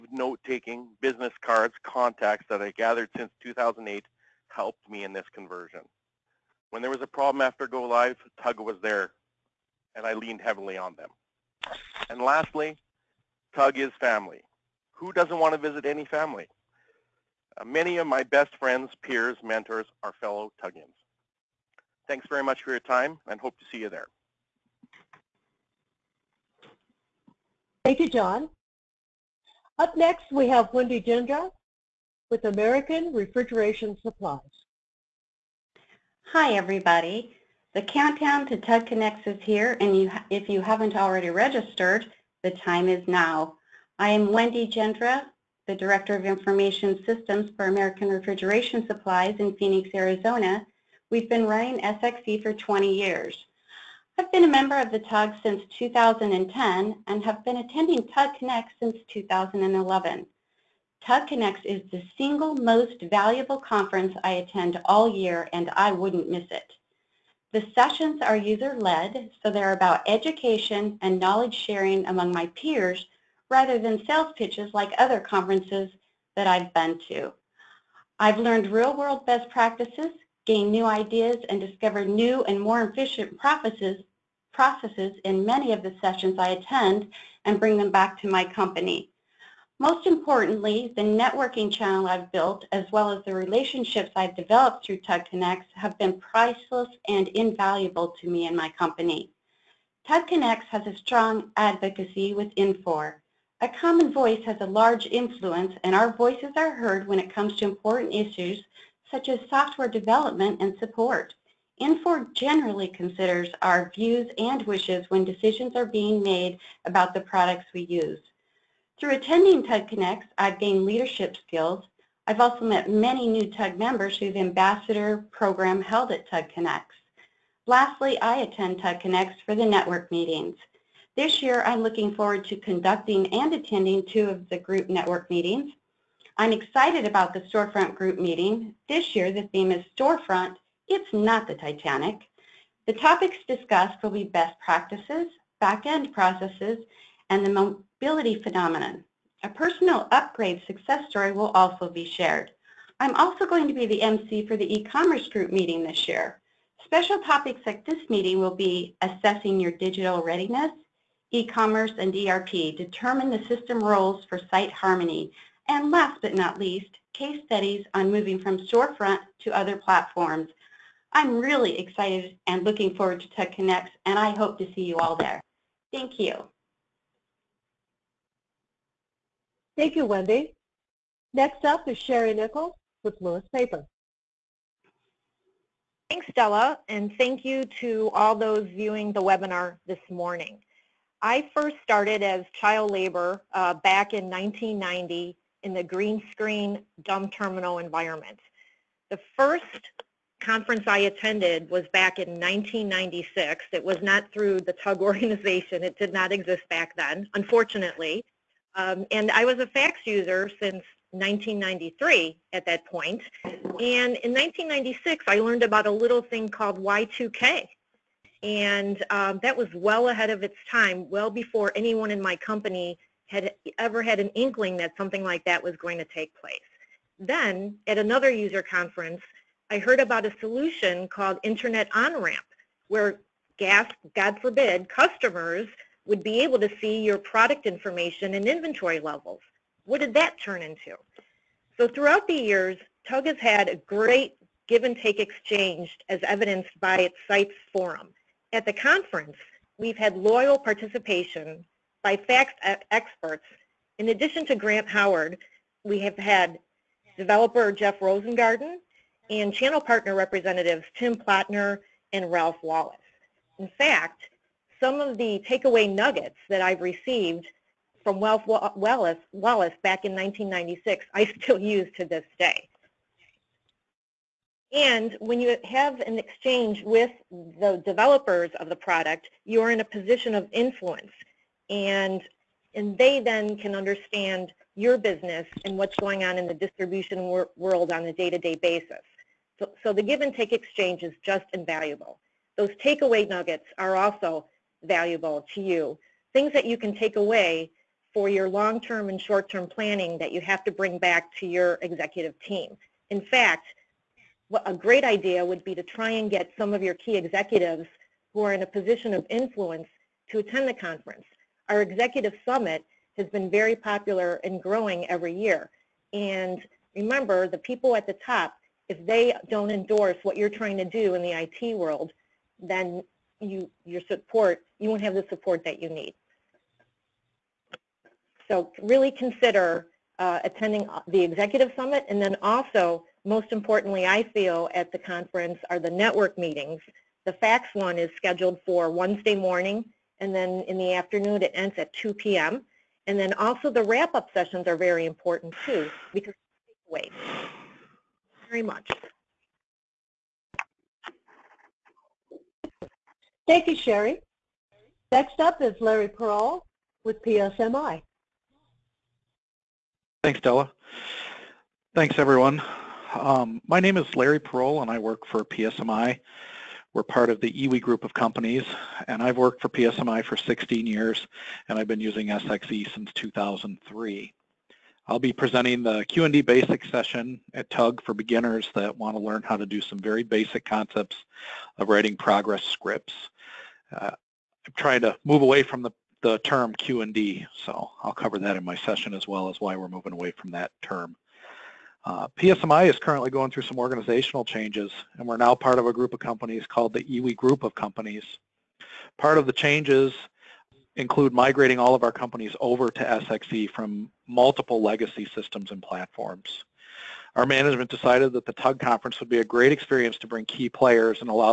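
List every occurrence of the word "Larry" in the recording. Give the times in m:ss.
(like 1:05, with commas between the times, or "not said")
5:55, 6:04.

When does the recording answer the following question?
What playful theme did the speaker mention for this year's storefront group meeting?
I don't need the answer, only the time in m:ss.
2:20.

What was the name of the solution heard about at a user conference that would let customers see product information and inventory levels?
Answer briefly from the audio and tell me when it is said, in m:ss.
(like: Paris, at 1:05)
Internet On-Ramp, at 3:51.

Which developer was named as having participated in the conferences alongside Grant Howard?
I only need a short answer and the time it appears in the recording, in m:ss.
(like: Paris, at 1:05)
Jeff Rosengarten, at 4:17.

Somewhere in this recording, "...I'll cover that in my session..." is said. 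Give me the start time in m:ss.
6:28.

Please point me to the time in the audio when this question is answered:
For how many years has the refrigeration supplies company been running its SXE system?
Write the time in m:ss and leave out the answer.
0:52.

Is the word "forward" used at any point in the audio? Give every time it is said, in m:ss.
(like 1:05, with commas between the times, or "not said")
2:12, 2:52.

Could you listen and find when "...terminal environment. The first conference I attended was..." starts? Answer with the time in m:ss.
3:17.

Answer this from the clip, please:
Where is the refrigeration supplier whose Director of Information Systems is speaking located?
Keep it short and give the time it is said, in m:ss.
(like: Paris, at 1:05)
Phoenix, Arizona, at 0:49.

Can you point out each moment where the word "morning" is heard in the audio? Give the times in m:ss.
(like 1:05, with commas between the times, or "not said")
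3:10, 5:39.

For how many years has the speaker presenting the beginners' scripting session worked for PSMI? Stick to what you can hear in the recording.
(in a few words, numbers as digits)
16 years.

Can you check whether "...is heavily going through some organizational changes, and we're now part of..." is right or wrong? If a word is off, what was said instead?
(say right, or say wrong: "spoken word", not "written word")
wrong: "currently", not "heavily".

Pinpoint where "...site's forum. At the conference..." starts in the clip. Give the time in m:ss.
4:07.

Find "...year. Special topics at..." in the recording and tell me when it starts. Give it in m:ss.
2:36.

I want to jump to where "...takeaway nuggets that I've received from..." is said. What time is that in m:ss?
4:25.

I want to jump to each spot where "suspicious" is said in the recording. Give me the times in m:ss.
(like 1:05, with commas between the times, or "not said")
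not said.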